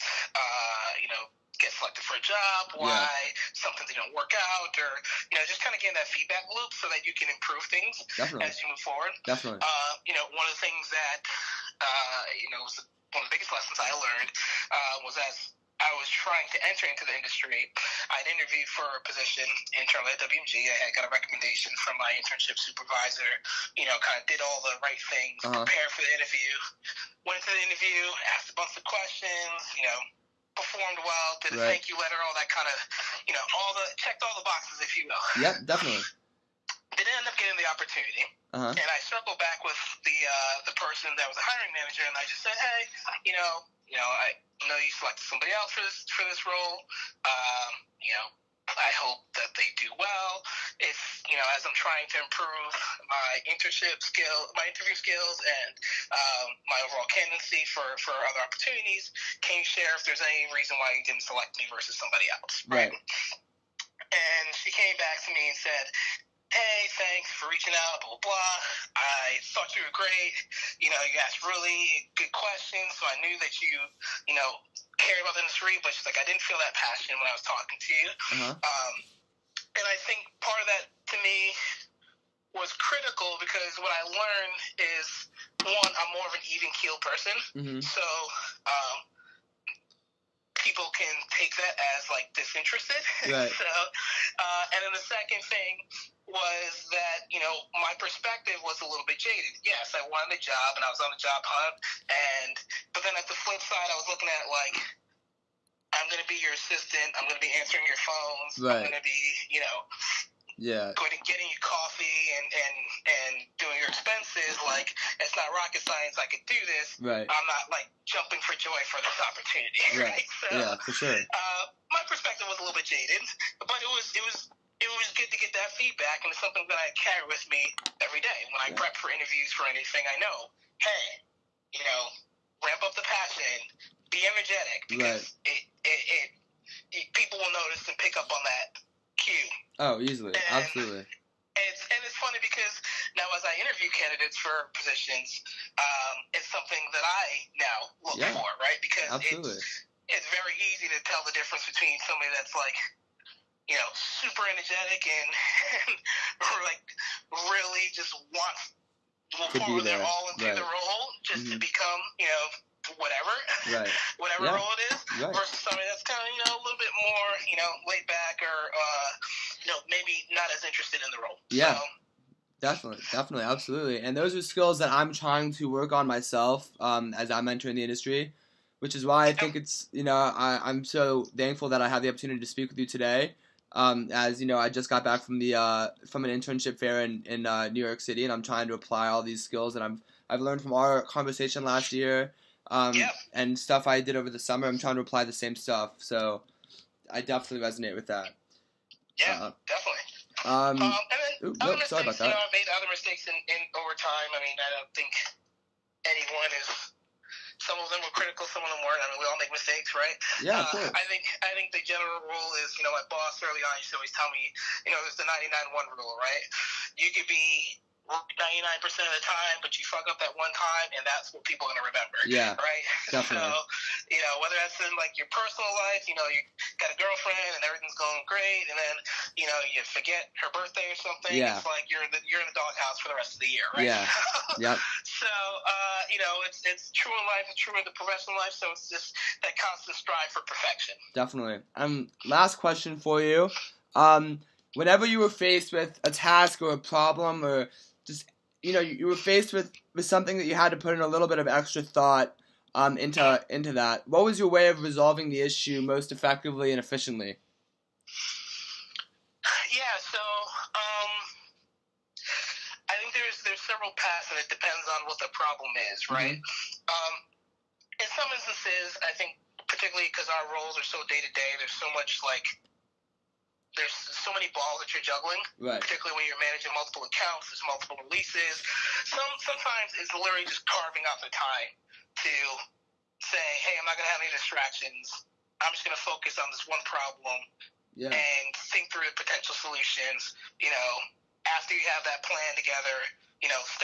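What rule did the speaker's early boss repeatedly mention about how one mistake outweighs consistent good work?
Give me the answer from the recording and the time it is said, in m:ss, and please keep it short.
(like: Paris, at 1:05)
99-1 rule, at 3:35.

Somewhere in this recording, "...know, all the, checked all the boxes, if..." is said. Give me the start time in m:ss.
0:33.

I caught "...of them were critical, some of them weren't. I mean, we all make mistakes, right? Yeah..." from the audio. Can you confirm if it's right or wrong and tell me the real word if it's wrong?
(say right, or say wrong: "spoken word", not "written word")
right.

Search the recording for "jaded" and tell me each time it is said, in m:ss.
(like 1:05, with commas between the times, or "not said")
1:39, 2:02.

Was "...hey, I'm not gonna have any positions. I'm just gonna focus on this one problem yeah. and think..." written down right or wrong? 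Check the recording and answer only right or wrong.
wrong.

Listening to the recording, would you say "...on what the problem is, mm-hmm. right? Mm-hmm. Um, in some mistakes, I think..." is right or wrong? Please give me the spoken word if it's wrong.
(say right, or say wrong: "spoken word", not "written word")
wrong: "instances", not "mistakes".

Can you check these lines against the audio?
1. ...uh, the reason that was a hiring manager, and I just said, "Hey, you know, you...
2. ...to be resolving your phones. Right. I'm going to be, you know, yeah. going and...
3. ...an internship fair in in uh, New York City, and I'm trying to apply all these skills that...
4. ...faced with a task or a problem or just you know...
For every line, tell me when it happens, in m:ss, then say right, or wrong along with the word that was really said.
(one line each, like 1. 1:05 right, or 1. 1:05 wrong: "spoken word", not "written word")
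1. 0:40 wrong: "person", not "reason"
2. 1:47 wrong: "answering", not "resolving"
3. 3:06 right
4. 4:05 right.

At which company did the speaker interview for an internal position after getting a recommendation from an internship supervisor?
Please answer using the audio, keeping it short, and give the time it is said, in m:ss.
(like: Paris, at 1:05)
WMG, at 0:20.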